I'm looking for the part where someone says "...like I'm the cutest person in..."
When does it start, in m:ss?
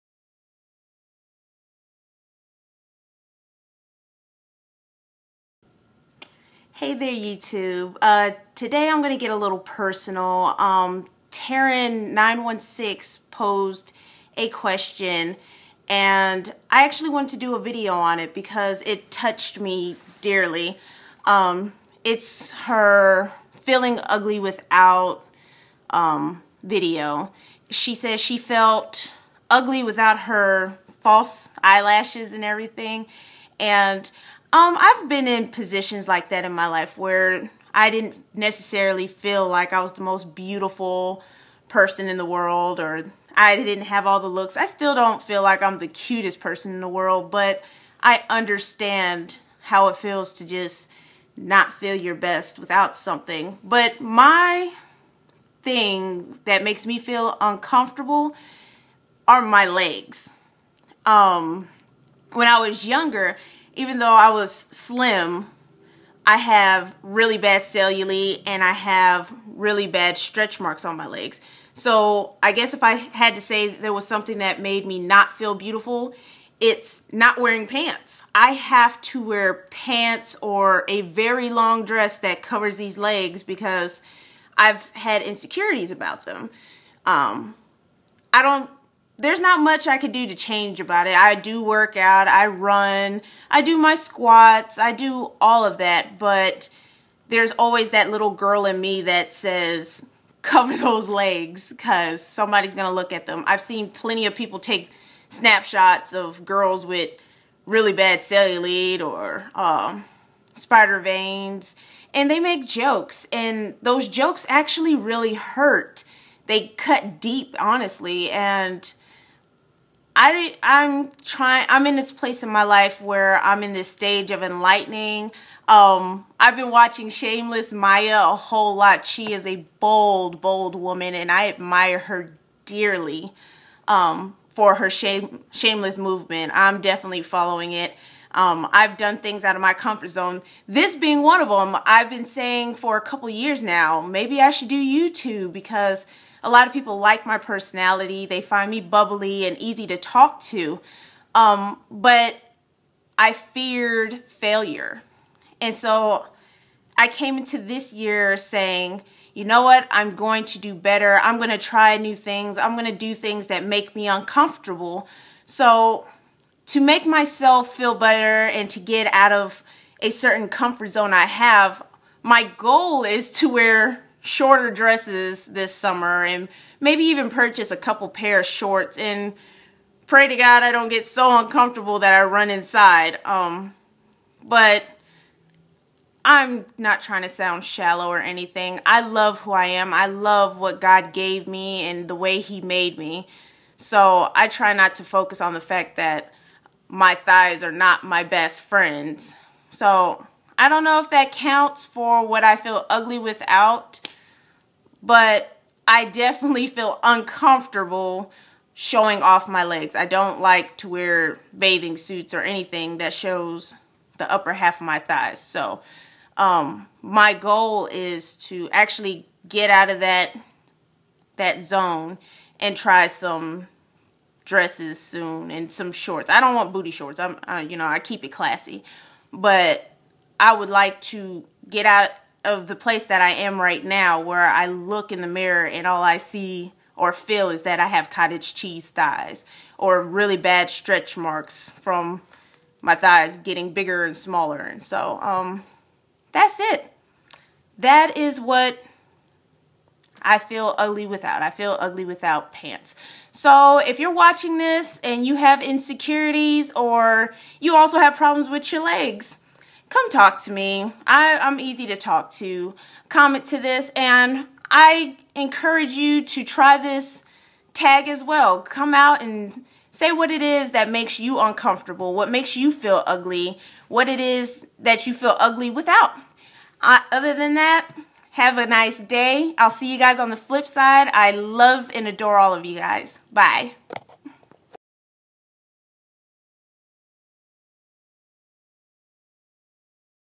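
0:45.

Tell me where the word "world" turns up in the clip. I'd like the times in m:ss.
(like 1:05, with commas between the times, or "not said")
0:42, 0:46.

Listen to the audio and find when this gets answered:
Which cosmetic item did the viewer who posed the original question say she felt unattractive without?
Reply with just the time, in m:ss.
0:30.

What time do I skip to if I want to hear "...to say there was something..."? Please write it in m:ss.
1:13.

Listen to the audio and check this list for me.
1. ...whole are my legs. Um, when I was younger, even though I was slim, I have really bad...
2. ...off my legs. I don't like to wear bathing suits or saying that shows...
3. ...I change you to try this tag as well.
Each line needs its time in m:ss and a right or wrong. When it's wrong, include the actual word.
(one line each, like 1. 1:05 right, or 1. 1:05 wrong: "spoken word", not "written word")
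1. 0:57 wrong: "uncomfortable", not "whole"
2. 3:29 wrong: "anything", not "saying"
3. 4:24 wrong: "encourage", not "change".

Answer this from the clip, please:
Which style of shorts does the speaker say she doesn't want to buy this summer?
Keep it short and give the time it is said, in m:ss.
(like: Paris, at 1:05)
booty shorts, at 3:46.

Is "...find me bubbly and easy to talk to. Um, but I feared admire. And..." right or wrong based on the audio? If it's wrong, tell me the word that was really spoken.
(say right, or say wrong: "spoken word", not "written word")
wrong: "failure", not "admire".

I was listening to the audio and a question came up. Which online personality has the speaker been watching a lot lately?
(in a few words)
Shameless Maya.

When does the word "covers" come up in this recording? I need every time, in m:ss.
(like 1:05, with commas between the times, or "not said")
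1:22, 1:40.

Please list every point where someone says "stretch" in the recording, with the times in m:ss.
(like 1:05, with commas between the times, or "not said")
1:10, 4:00.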